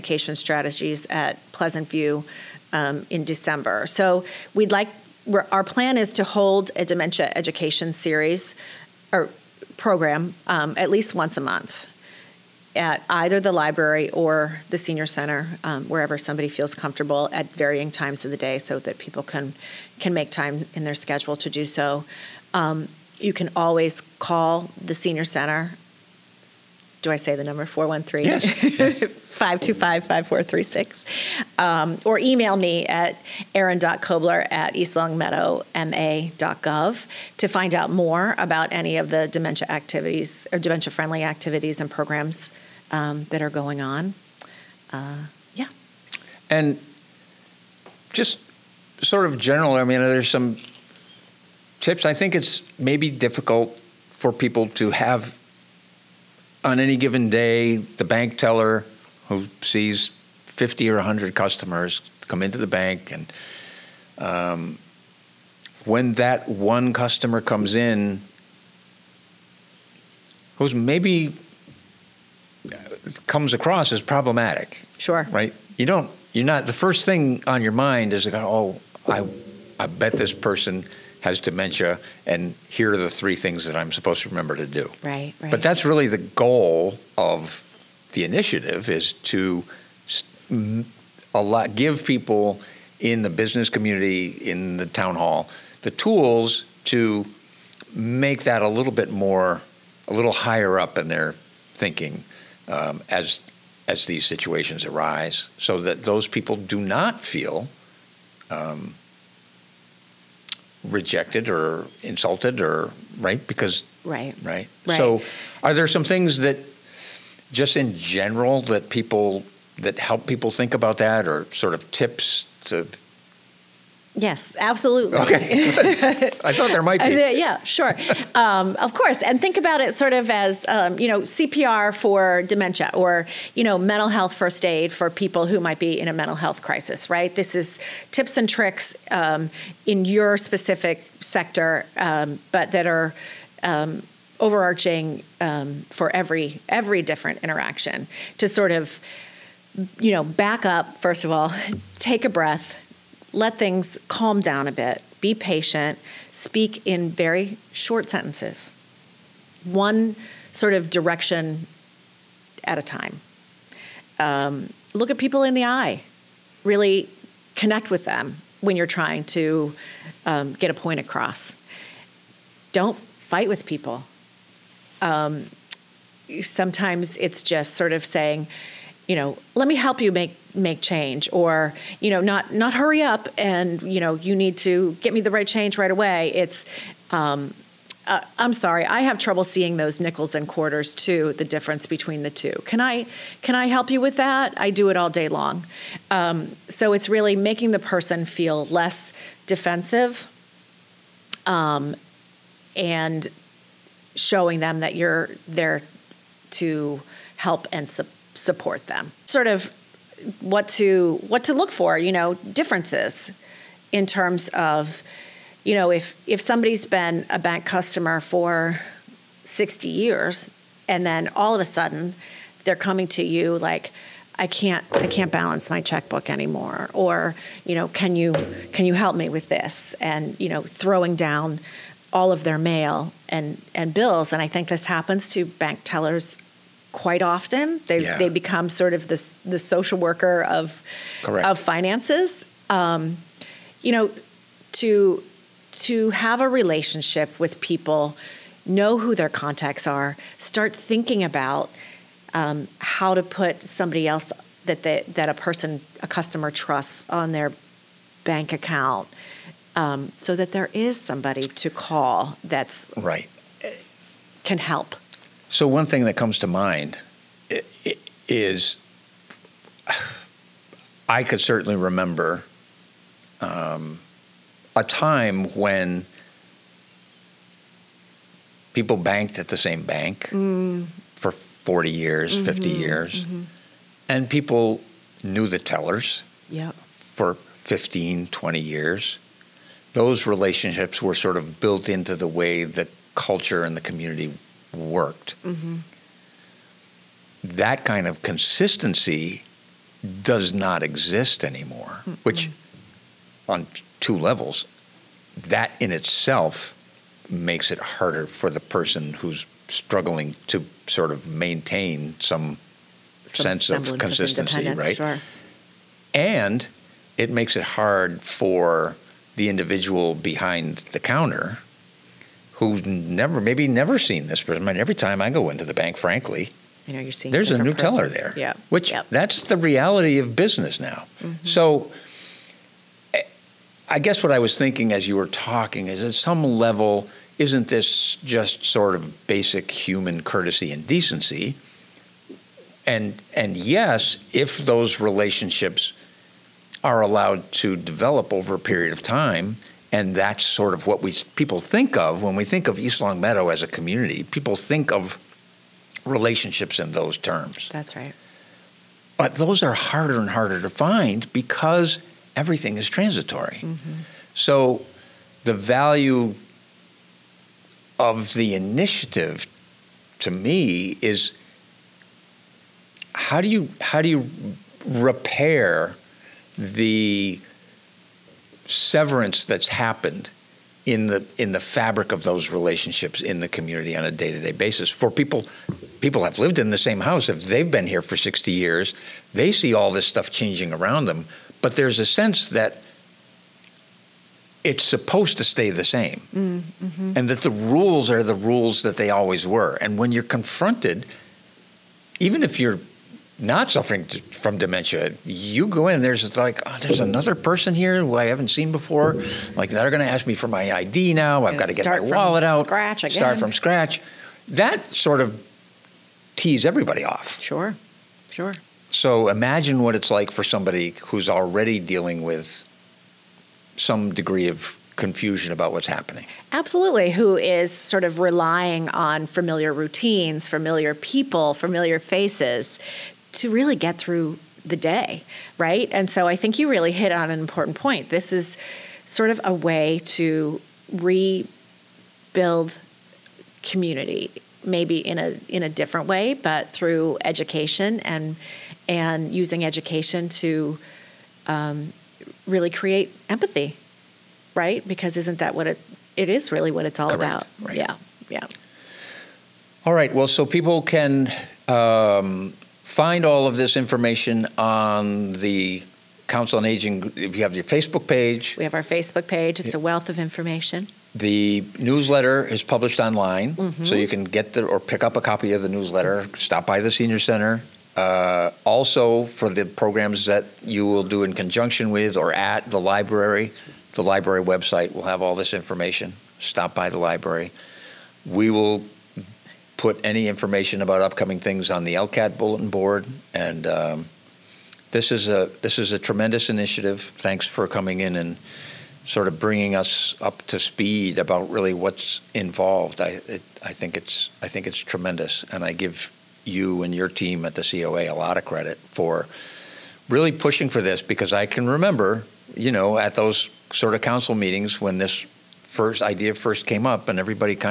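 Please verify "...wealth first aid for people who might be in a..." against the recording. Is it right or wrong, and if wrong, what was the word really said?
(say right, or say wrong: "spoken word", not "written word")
wrong: "health", not "wealth".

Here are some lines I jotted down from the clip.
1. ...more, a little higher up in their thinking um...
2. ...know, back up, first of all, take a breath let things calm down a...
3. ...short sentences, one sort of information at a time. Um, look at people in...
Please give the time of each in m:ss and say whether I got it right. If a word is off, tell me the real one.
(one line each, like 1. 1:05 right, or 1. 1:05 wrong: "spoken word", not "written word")
1. 1:39 right
2. 2:30 right
3. 2:37 wrong: "direction", not "information".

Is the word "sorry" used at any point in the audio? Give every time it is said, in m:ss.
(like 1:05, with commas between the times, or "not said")
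3:08.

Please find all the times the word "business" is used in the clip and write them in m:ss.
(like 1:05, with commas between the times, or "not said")
1:33, 5:30.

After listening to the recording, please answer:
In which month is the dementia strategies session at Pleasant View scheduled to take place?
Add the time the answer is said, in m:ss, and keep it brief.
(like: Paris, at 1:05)
December, at 0:03.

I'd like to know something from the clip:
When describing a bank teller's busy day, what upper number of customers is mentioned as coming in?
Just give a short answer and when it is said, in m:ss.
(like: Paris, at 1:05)
100, at 1:00.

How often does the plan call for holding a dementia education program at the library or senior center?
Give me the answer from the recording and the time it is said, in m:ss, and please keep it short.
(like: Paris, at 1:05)
once a month, at 0:11.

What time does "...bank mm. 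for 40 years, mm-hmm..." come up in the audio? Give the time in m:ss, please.
4:39.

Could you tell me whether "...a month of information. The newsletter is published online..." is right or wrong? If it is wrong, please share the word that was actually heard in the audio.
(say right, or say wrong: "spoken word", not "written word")
wrong: "wealth", not "month".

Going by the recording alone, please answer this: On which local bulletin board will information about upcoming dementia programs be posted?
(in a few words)
ELCAT.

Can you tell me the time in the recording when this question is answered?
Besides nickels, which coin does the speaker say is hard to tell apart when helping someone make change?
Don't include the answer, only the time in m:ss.
3:10.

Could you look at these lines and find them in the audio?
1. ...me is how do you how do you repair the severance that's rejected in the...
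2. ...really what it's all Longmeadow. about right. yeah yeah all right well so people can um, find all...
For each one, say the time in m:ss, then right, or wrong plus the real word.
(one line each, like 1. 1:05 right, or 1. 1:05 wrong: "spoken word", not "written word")
1. 6:10 wrong: "happened", not "rejected"
2. 7:36 wrong: "Correct", not "Longmeadow".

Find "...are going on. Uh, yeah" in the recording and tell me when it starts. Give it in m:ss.
0:43.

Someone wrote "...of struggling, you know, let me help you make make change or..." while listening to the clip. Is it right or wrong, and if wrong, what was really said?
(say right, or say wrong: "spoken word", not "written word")
wrong: "saying", not "struggling".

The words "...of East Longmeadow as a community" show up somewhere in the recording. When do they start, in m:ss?
5:52.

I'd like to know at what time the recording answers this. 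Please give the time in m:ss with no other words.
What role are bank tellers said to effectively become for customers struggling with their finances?
3:59.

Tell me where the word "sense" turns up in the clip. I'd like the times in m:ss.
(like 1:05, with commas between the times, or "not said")
5:13, 6:32.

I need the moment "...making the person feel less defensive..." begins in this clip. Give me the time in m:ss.
3:17.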